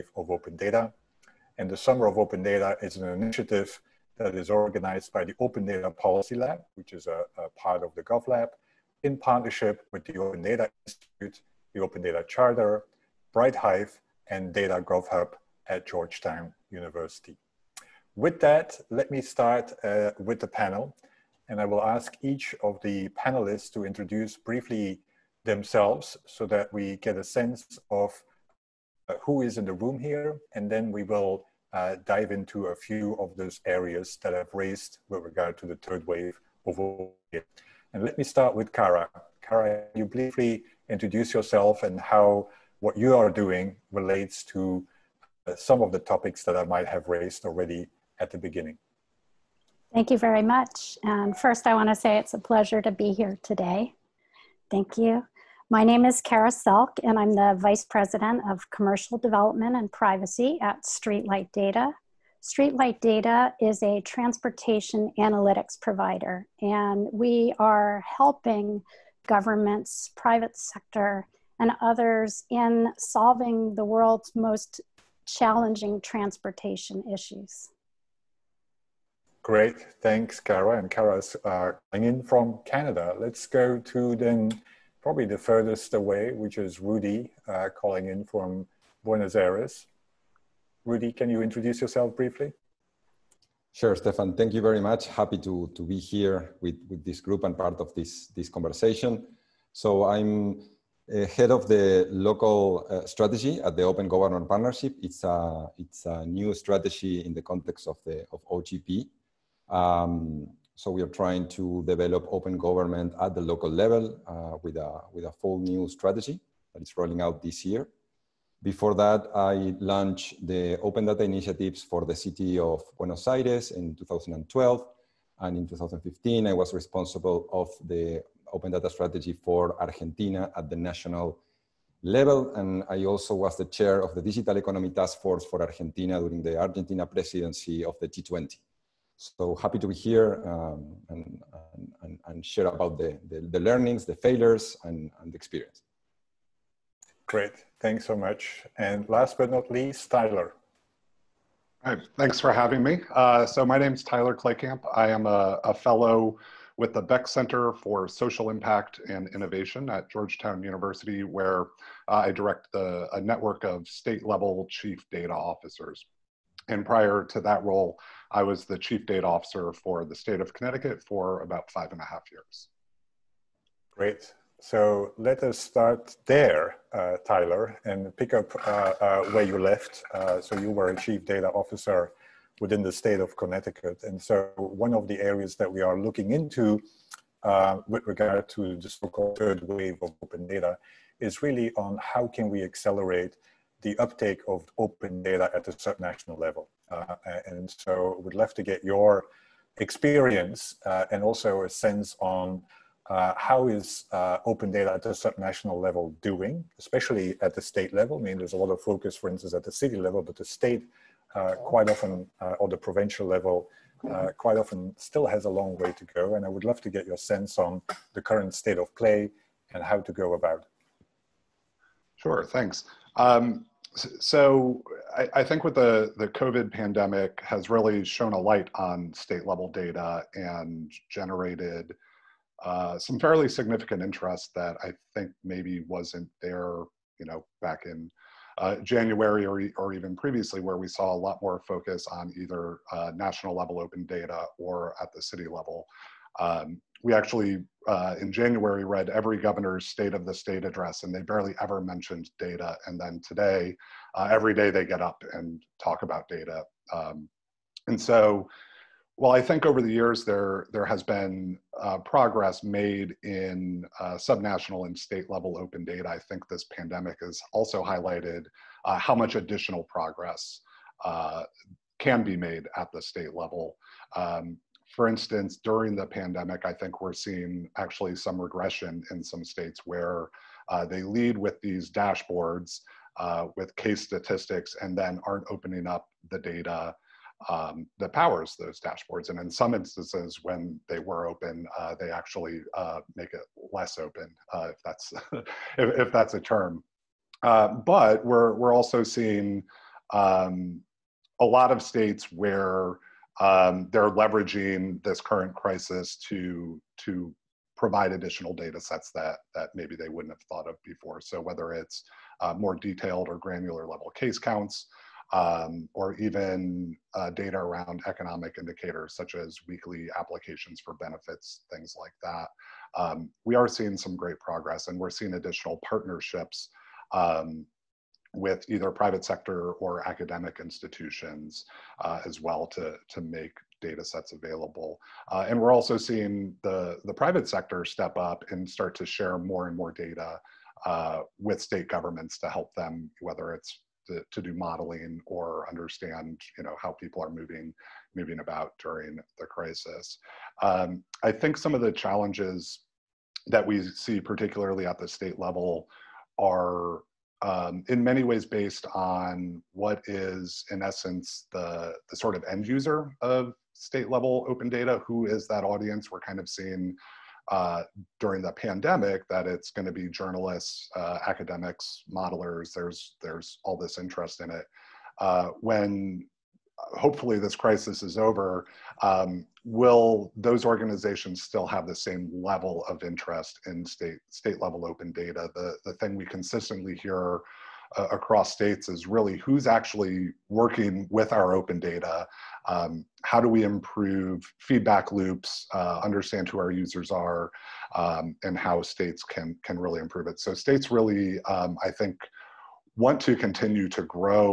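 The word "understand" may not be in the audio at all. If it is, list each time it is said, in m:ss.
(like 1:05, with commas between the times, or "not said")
5:45, 6:36.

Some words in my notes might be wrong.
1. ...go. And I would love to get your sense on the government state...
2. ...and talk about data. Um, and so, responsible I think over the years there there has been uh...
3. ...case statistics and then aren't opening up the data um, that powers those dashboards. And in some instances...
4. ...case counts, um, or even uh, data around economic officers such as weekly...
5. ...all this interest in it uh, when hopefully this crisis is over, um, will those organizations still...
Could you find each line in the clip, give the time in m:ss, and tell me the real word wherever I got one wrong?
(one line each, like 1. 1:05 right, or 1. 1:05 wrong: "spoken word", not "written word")
1. 3:36 wrong: "current", not "government"
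2. 4:15 wrong: "while", not "responsible"
3. 4:43 right
4. 5:14 wrong: "indicators", not "officers"
5. 6:13 right.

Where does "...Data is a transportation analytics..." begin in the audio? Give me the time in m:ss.
1:03.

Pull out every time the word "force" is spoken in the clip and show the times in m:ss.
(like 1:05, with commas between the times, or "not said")
2:15.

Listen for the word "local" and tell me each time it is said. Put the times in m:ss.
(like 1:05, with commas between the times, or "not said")
1:42, 1:53.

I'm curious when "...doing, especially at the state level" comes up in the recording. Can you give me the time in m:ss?
3:26.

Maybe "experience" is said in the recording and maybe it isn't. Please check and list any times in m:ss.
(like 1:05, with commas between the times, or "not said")
2:25, 3:19.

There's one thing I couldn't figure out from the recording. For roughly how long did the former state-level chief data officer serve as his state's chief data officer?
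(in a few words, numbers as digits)
5 and a half years.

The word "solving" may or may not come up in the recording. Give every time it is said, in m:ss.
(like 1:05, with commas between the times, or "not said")
1:12.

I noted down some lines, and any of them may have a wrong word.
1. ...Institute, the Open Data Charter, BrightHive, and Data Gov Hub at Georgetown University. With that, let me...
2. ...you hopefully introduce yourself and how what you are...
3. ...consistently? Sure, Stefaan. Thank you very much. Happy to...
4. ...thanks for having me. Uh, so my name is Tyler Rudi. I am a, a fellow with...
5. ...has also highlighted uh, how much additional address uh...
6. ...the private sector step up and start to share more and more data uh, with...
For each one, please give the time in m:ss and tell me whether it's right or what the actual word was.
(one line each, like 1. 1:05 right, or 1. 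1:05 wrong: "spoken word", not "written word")
1. 0:10 right
2. 0:39 wrong: "briefly", not "hopefully"
3. 1:32 wrong: "briefly", not "consistently"
4. 2:32 wrong: "Kleykamp", not "Rudi"
5. 4:27 wrong: "progress", not "address"
6. 5:37 right.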